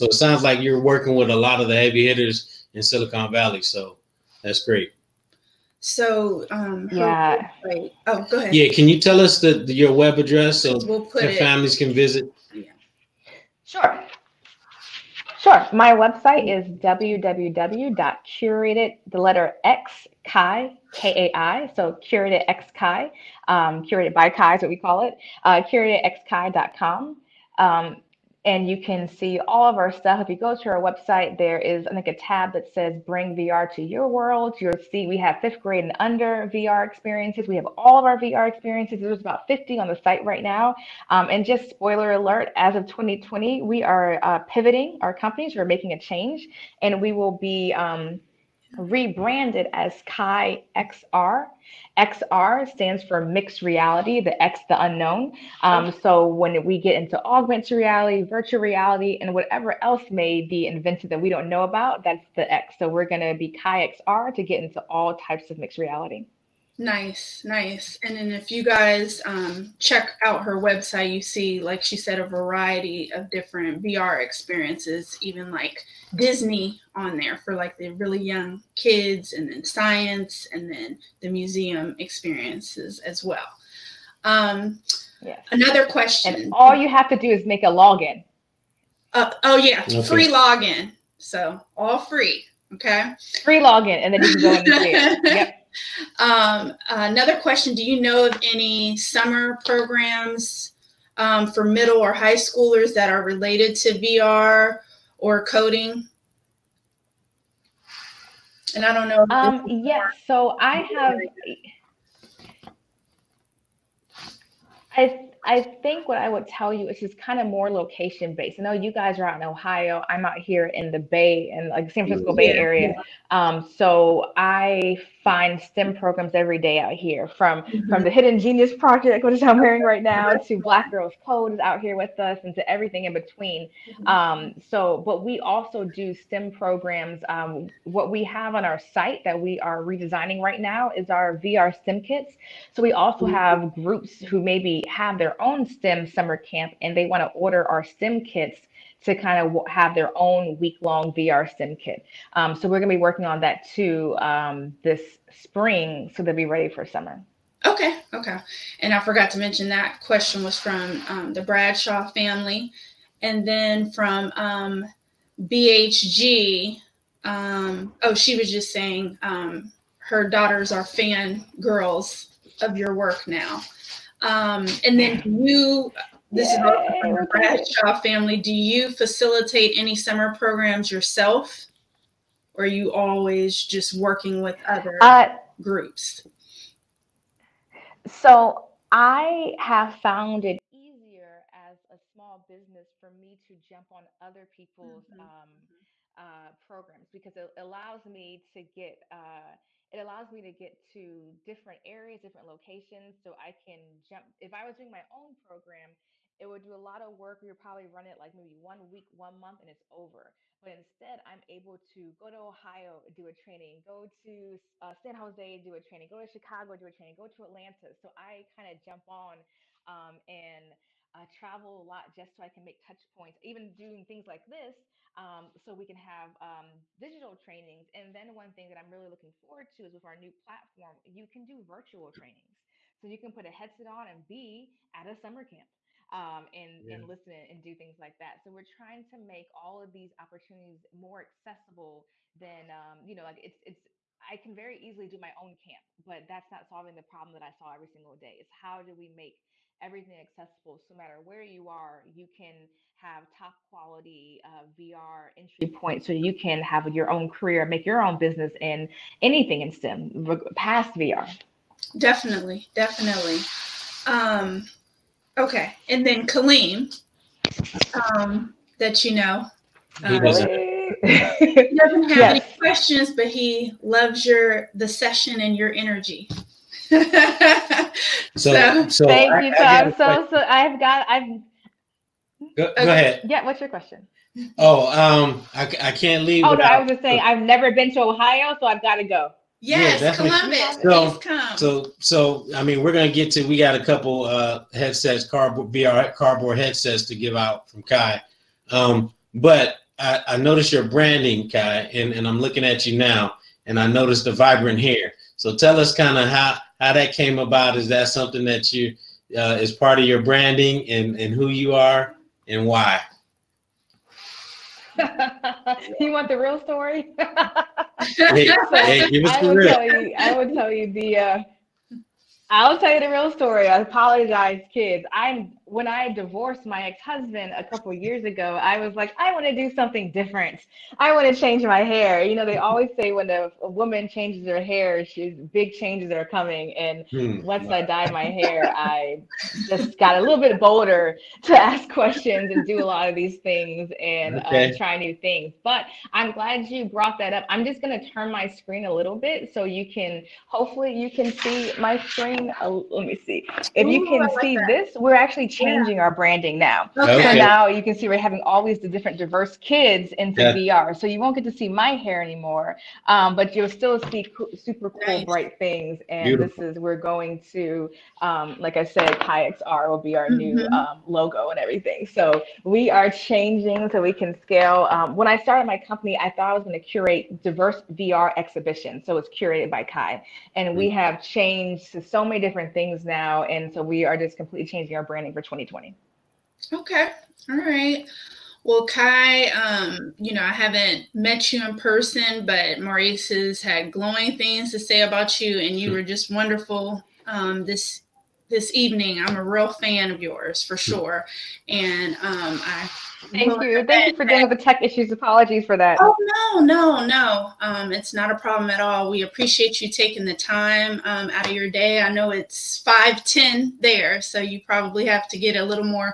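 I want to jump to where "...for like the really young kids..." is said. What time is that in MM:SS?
01:17.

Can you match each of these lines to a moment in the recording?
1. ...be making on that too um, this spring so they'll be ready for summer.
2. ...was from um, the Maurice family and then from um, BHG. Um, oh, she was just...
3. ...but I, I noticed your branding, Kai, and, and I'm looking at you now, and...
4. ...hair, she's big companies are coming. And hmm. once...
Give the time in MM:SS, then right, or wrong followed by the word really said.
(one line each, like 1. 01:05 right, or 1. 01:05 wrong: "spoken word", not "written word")
1. 02:32 wrong: "working", not "making"
2. 02:40 wrong: "Bradshaw", not "Maurice"
3. 04:59 right
4. 05:34 wrong: "changes", not "companies".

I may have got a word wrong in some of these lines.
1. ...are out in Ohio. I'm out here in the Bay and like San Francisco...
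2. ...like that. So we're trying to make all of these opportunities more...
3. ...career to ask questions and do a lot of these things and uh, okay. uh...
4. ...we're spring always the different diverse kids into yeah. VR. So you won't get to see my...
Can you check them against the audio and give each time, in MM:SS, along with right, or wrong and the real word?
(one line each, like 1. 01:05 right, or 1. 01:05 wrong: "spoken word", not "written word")
1. 01:59 right
2. 03:57 right
3. 05:40 wrong: "bolder", not "career"
4. 05:58 wrong: "having", not "spring".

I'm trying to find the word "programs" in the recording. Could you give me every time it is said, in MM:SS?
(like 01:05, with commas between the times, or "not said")
01:39, 02:05, 02:16, 03:00, 03:16, 03:25.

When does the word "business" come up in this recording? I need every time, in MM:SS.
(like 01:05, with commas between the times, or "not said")
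03:12, 04:18.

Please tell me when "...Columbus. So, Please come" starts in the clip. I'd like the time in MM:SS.
04:50.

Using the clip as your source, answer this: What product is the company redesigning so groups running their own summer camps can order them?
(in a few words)
VR STEM kits.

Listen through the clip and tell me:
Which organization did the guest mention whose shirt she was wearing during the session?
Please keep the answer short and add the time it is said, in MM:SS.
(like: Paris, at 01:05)
Hidden Genius Project, at 02:08.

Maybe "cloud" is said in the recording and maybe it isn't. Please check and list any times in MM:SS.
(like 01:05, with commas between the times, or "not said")
not said.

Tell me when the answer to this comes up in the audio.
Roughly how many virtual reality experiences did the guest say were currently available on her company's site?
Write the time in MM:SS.
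00:39.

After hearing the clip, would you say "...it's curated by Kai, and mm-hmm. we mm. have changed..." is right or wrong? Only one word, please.
right.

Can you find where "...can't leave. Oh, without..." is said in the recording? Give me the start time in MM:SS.
04:45.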